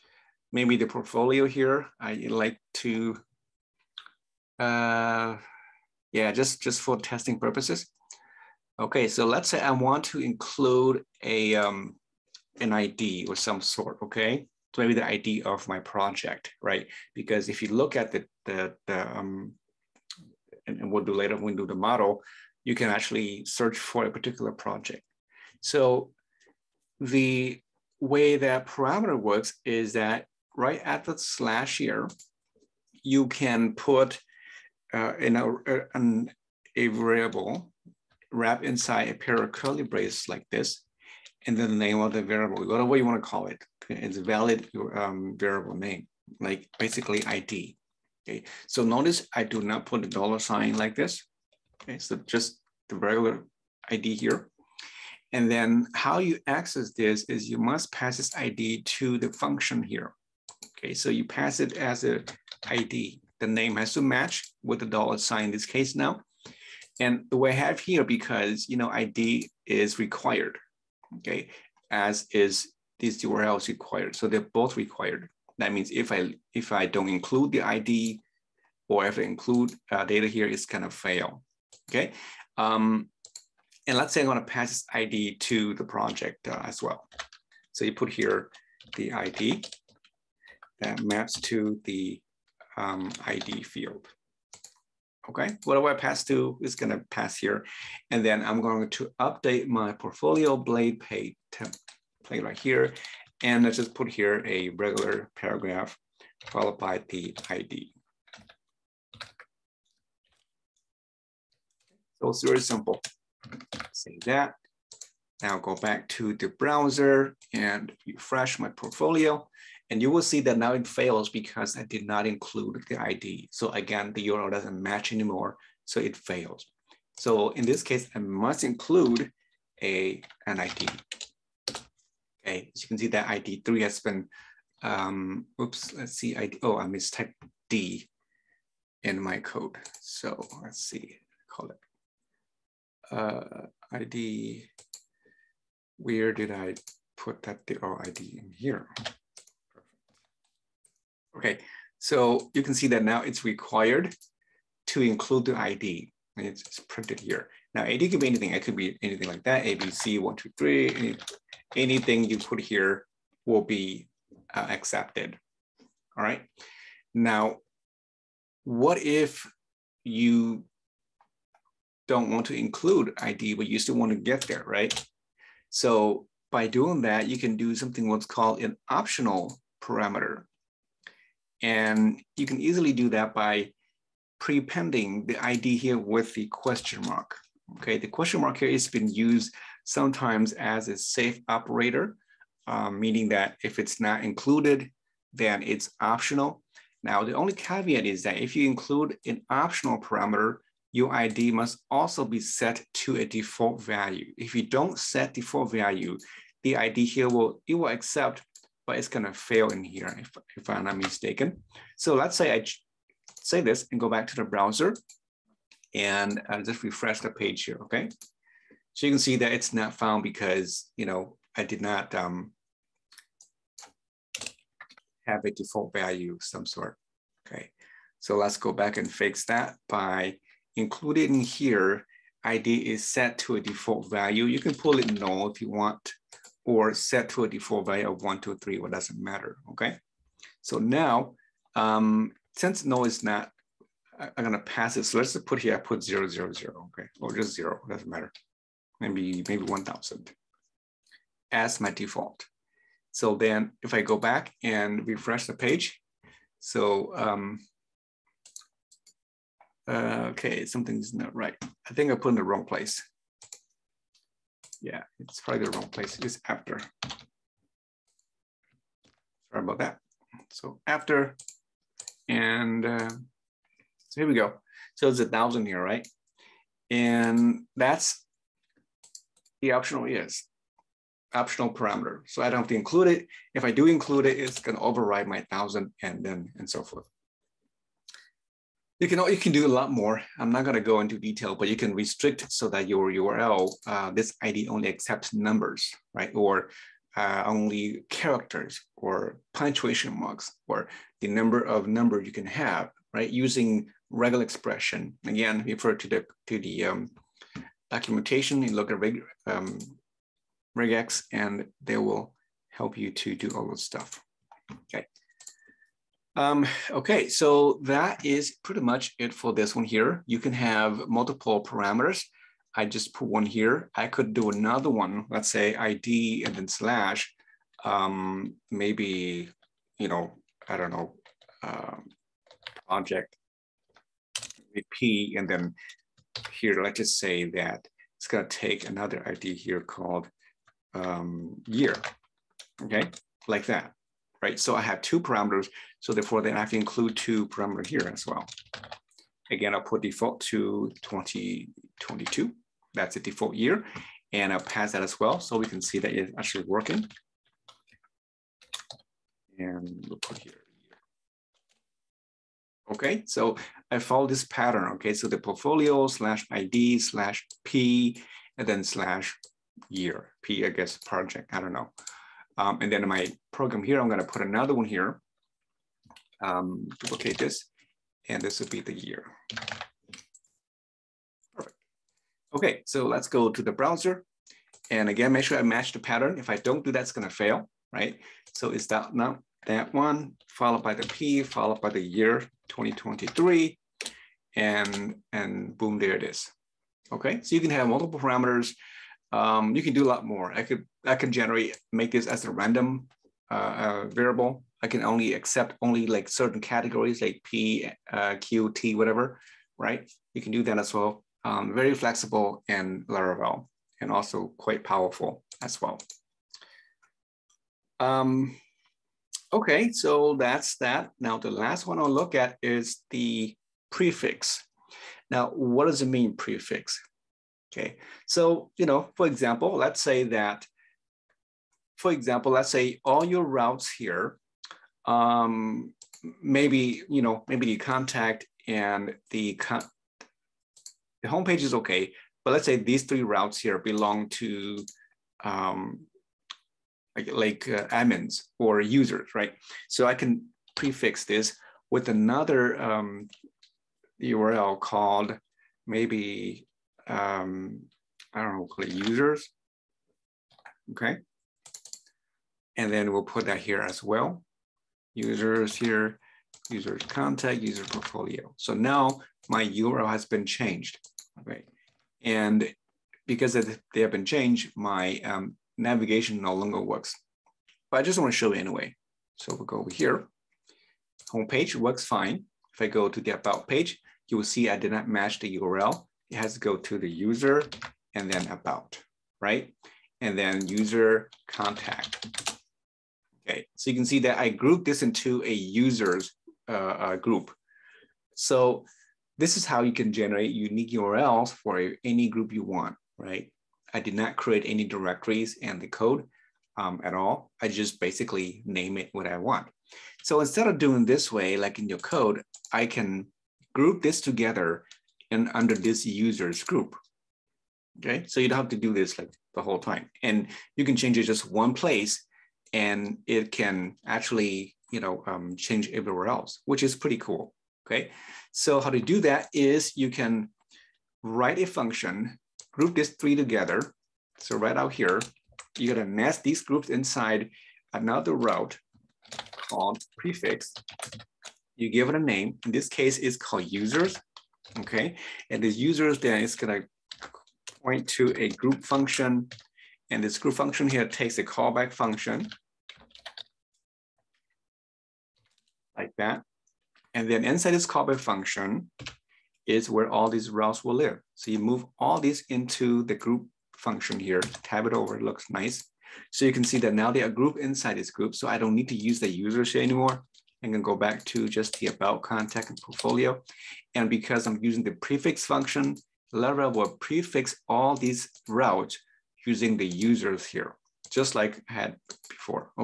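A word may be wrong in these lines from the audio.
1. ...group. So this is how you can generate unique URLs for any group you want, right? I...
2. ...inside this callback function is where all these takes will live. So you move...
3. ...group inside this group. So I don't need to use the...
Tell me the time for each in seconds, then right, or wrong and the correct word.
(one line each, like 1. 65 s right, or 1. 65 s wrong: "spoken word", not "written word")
1. 497 s right
2. 557 s wrong: "routes", not "takes"
3. 567 s right.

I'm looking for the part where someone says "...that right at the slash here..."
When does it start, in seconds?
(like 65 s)
29 s.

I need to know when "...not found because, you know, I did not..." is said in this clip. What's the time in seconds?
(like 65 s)
219 s.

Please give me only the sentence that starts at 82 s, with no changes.
Um, and let's say I'm gonna pass this ID to the project uh, as well.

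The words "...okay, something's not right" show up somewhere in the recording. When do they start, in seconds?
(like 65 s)
260 s.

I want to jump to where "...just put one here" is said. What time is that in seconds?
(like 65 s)
322 s.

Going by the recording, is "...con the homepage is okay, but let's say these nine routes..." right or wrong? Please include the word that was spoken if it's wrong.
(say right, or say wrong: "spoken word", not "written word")
wrong: "three", not "nine".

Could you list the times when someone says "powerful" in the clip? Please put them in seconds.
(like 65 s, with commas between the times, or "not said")
414 s.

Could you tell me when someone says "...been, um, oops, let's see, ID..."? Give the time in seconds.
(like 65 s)
134 s.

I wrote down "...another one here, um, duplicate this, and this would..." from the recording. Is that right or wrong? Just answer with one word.
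right.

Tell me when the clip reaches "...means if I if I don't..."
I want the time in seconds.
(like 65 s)
75 s.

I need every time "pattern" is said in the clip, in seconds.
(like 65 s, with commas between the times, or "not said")
364 s, 385 s.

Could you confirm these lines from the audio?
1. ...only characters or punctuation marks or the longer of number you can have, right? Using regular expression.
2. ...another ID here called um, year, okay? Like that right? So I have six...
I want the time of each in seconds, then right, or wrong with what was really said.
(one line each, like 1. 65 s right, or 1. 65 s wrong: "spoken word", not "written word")
1. 297 s wrong: "number", not "longer"
2. 338 s wrong: "two", not "six".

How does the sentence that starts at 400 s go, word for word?
I could I can generate make this as a random uh, uh, variable.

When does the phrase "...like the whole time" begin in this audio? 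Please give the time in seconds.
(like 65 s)
519 s.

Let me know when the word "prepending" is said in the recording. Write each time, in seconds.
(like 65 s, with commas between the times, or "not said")
184 s.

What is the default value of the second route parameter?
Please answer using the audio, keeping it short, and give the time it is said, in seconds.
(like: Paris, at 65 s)
2022, at 351 s.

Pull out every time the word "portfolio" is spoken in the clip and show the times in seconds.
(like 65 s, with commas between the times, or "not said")
0 s, 99 s, 118 s, 365 s, 467 s, 572 s.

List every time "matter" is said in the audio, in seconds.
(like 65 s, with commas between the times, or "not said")
239 s, 248 s.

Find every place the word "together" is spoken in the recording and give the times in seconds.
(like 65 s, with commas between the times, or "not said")
514 s, 533 s.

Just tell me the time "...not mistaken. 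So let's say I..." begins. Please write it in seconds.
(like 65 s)
210 s.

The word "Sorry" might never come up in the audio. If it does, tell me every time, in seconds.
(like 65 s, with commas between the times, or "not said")
269 s.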